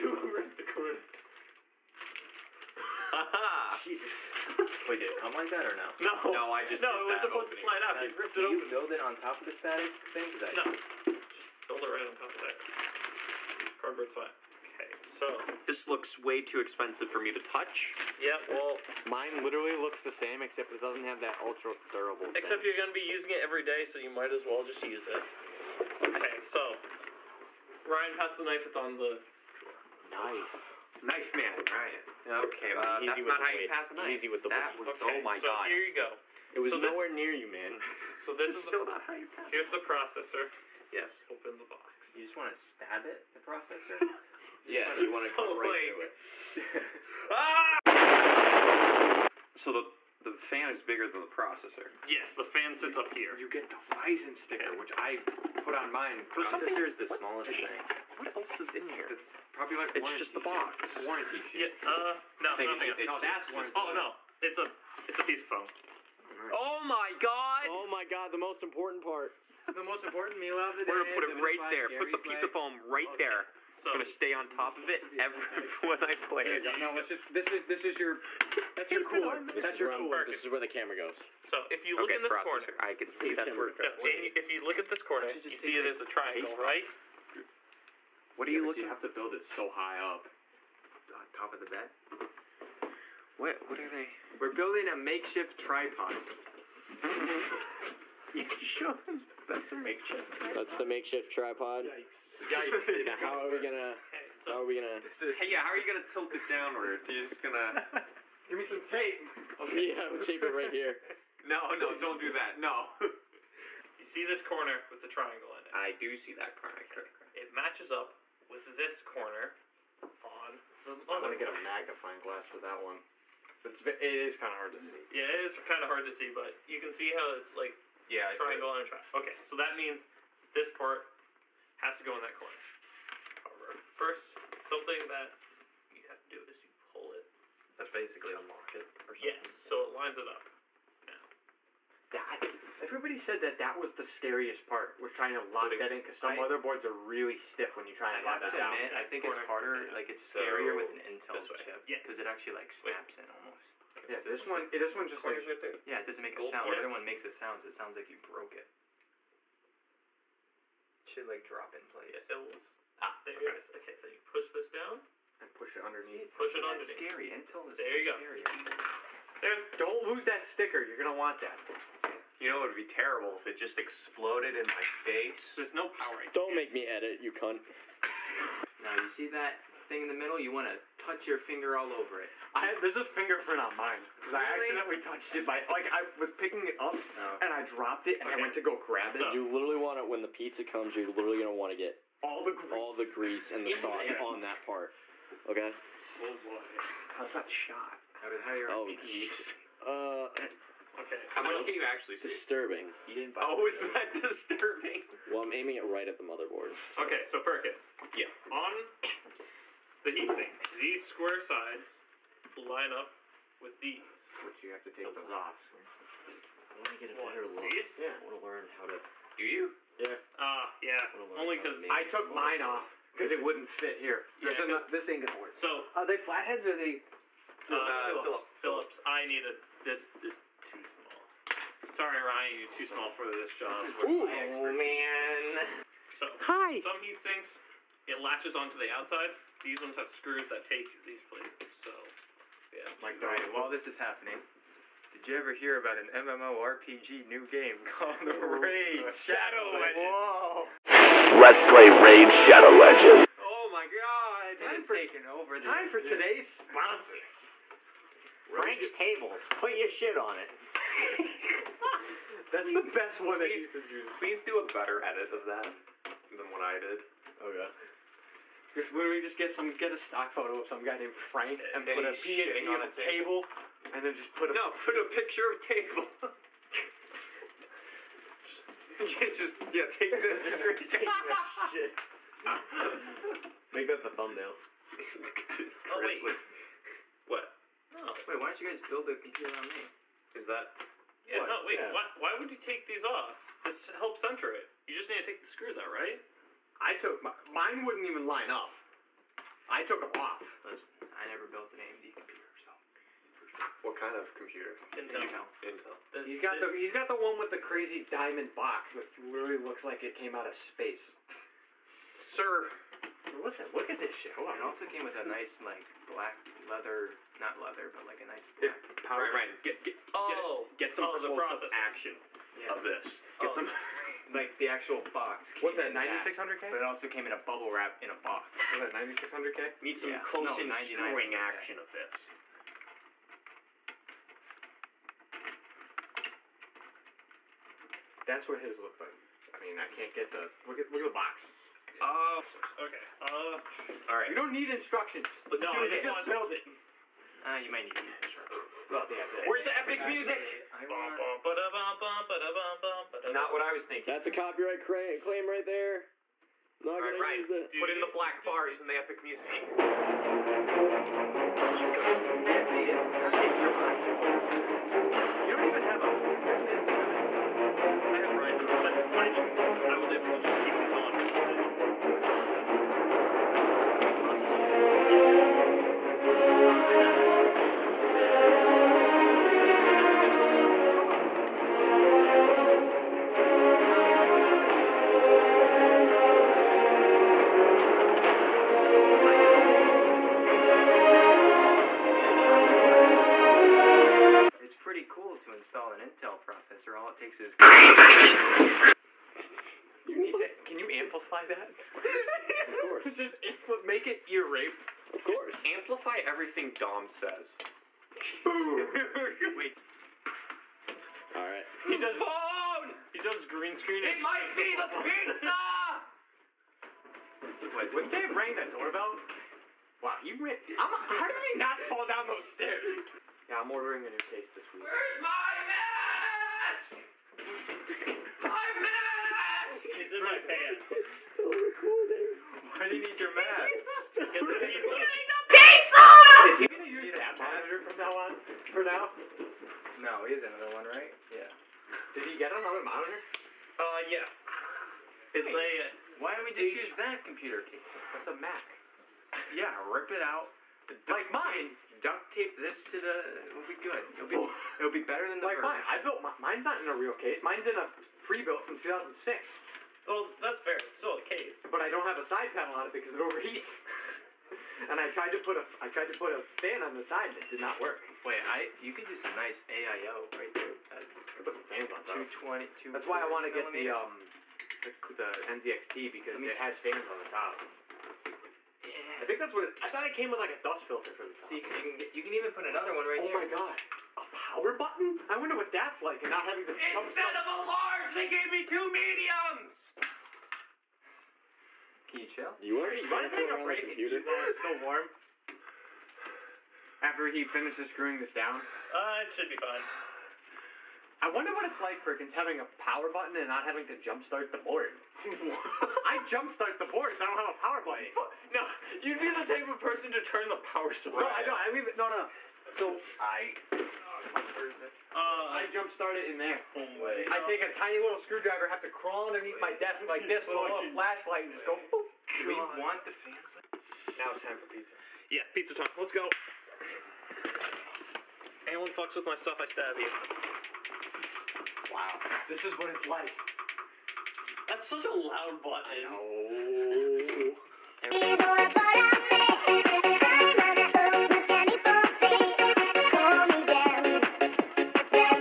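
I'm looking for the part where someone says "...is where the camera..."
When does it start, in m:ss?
1:20.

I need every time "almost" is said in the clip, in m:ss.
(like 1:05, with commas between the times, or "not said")
2:33.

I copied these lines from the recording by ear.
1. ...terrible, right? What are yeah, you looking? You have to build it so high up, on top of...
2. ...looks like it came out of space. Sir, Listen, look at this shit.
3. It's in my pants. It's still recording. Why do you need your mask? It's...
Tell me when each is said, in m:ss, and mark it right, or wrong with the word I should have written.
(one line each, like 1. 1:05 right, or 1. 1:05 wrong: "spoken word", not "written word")
1. 1:26 wrong: "triangle", not "terrible"
2. 5:09 right
3. 7:09 right.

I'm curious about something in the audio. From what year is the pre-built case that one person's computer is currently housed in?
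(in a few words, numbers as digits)
2006.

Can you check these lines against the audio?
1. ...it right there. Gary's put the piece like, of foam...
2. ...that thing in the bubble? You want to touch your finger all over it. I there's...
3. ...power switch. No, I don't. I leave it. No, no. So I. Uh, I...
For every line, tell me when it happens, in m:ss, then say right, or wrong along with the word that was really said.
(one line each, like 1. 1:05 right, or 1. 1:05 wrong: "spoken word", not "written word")
1. 1:11 right
2. 2:59 wrong: "middle", not "bubble"
3. 8:30 right.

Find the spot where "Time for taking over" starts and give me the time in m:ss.
4:14.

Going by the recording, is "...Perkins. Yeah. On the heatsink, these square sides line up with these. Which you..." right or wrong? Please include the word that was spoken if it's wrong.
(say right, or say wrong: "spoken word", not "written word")
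right.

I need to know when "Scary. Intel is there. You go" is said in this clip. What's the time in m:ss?
2:46.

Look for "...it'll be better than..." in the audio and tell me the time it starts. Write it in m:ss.
7:34.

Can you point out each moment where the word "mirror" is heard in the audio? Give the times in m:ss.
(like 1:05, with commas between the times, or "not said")
not said.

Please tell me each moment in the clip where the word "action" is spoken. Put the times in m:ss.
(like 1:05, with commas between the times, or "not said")
5:21, 5:31.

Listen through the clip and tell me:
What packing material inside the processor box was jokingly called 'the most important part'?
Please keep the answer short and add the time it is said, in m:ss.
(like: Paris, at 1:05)
a piece of foam, at 1:05.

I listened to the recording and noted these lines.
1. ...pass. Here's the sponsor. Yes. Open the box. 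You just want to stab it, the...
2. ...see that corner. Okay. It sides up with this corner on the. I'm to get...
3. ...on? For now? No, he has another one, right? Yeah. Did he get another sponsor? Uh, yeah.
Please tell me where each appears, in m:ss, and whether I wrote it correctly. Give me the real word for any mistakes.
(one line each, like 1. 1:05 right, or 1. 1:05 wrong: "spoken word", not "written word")
1. 0:39 wrong: "processor", not "sponsor"
2. 1:56 wrong: "matches", not "sides"
3. 7:18 wrong: "monitor", not "sponsor".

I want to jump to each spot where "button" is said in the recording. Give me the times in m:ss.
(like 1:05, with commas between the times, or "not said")
8:04, 8:23, 8:27, 8:55.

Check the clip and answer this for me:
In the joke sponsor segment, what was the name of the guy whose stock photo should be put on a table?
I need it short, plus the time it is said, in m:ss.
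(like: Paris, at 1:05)
Frank, at 4:31.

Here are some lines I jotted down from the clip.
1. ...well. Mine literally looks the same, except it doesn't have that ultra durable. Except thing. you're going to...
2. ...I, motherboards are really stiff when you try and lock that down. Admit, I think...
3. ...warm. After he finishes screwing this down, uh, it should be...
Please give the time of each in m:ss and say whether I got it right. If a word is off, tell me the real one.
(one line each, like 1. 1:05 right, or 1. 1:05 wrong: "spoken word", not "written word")
1. 0:18 right
2. 2:26 right
3. 8:14 right.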